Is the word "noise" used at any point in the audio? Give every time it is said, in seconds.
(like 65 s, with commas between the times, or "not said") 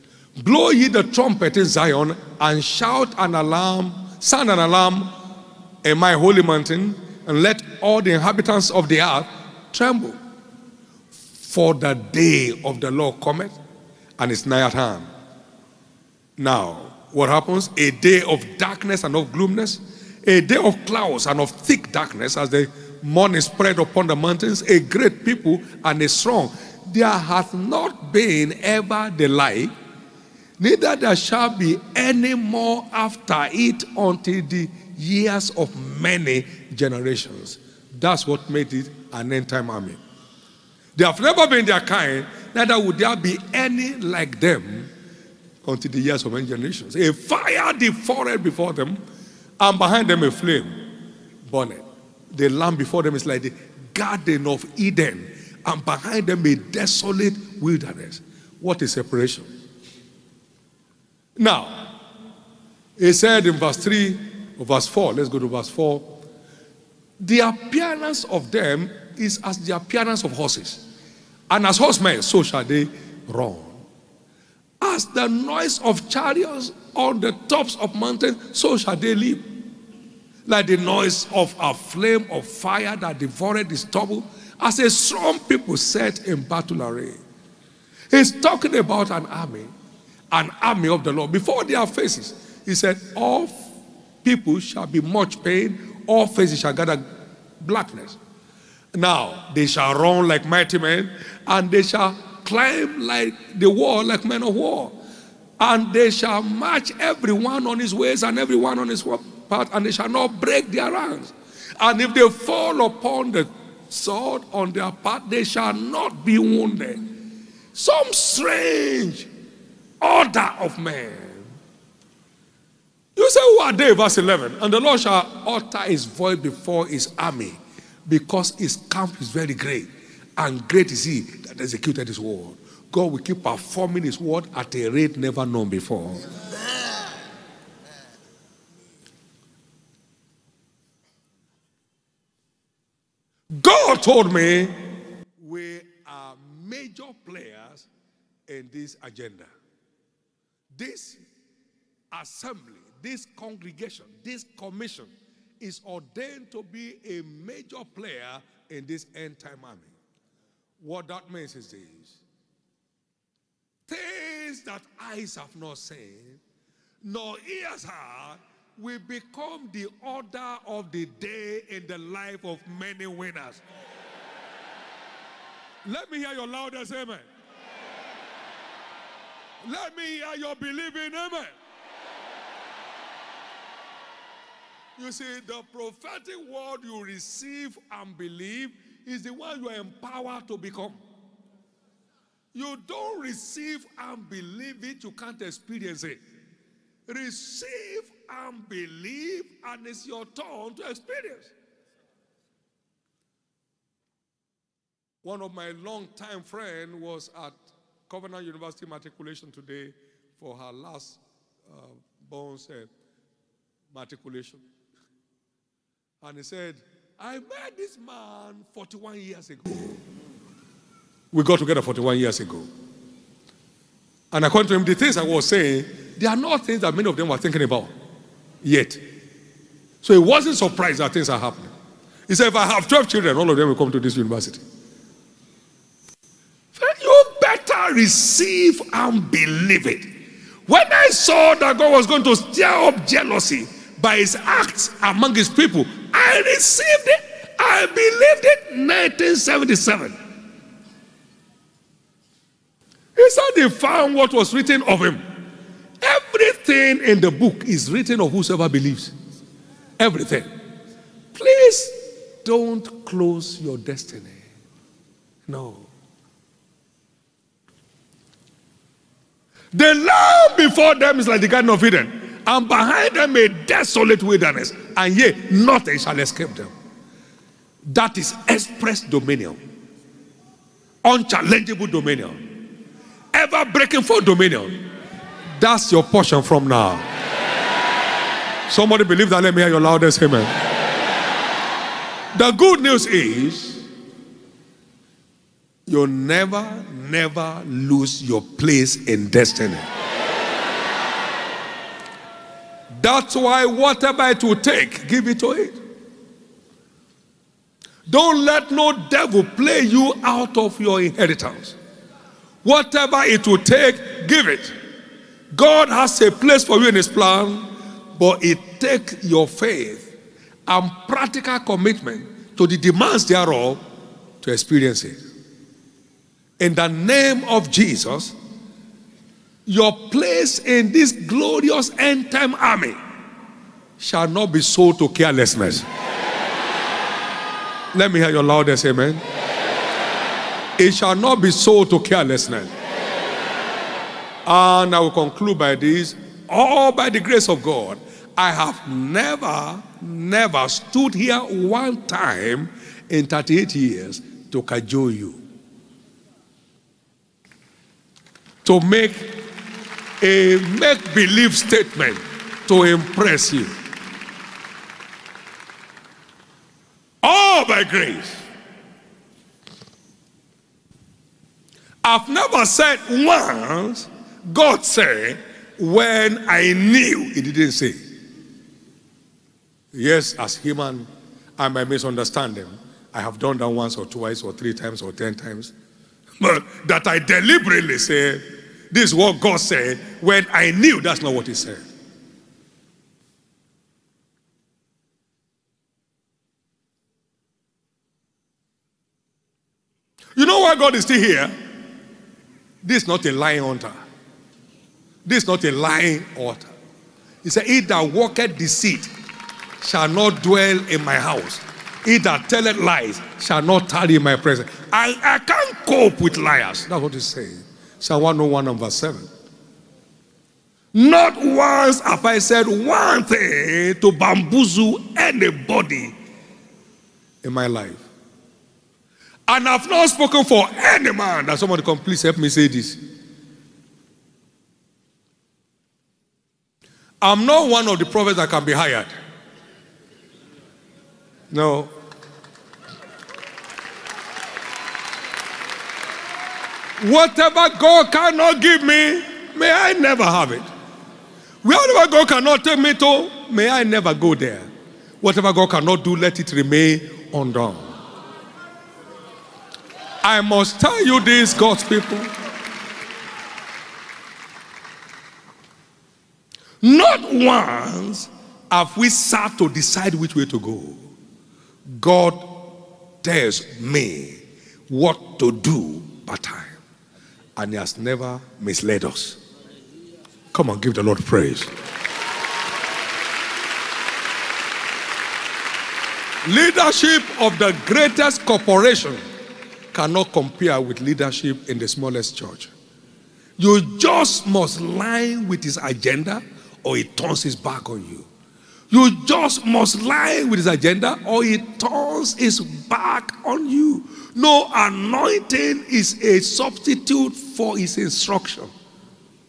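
75 s, 80 s.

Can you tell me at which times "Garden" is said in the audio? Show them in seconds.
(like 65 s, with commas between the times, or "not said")
53 s, 271 s.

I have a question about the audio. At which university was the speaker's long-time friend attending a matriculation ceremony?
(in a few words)
Covenant University.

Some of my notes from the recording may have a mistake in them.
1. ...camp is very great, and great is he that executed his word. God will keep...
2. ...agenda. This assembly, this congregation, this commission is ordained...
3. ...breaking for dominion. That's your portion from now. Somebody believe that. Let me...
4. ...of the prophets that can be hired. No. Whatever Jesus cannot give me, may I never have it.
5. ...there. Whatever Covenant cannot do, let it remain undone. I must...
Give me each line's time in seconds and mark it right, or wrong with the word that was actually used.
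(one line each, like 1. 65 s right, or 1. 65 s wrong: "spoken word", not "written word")
1. 128 s right
2. 149 s right
3. 283 s right
4. 437 s wrong: "God", not "Jesus"
5. 454 s wrong: "God", not "Covenant".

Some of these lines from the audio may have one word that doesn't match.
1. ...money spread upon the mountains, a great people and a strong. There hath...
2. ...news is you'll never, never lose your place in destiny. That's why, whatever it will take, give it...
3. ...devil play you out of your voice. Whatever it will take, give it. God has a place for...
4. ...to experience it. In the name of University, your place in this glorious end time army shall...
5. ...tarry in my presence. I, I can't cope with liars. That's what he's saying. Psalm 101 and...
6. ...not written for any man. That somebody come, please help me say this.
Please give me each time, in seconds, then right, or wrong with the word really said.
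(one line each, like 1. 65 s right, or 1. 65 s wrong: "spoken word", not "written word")
1. 23 s right
2. 292 s right
3. 309 s wrong: "inheritance", not "voice"
4. 324 s wrong: "Jesus", not "University"
5. 413 s right
6. 429 s wrong: "spoken", not "written".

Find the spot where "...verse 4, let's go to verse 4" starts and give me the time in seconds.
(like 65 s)
64 s.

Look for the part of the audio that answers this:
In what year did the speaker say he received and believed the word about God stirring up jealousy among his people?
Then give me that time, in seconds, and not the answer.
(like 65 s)
248 s.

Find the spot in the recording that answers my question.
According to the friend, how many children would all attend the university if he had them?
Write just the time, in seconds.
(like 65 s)
232 s.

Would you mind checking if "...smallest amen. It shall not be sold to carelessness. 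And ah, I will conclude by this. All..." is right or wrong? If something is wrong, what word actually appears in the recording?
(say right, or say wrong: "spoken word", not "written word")
wrong: "loudest", not "smallest".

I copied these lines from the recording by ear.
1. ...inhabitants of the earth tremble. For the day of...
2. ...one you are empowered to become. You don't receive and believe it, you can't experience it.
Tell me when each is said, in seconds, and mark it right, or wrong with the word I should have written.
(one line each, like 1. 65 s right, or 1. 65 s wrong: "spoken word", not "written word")
1. 8 s right
2. 189 s right.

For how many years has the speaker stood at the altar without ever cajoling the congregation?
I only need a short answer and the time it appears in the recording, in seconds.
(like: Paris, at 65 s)
38, at 353 s.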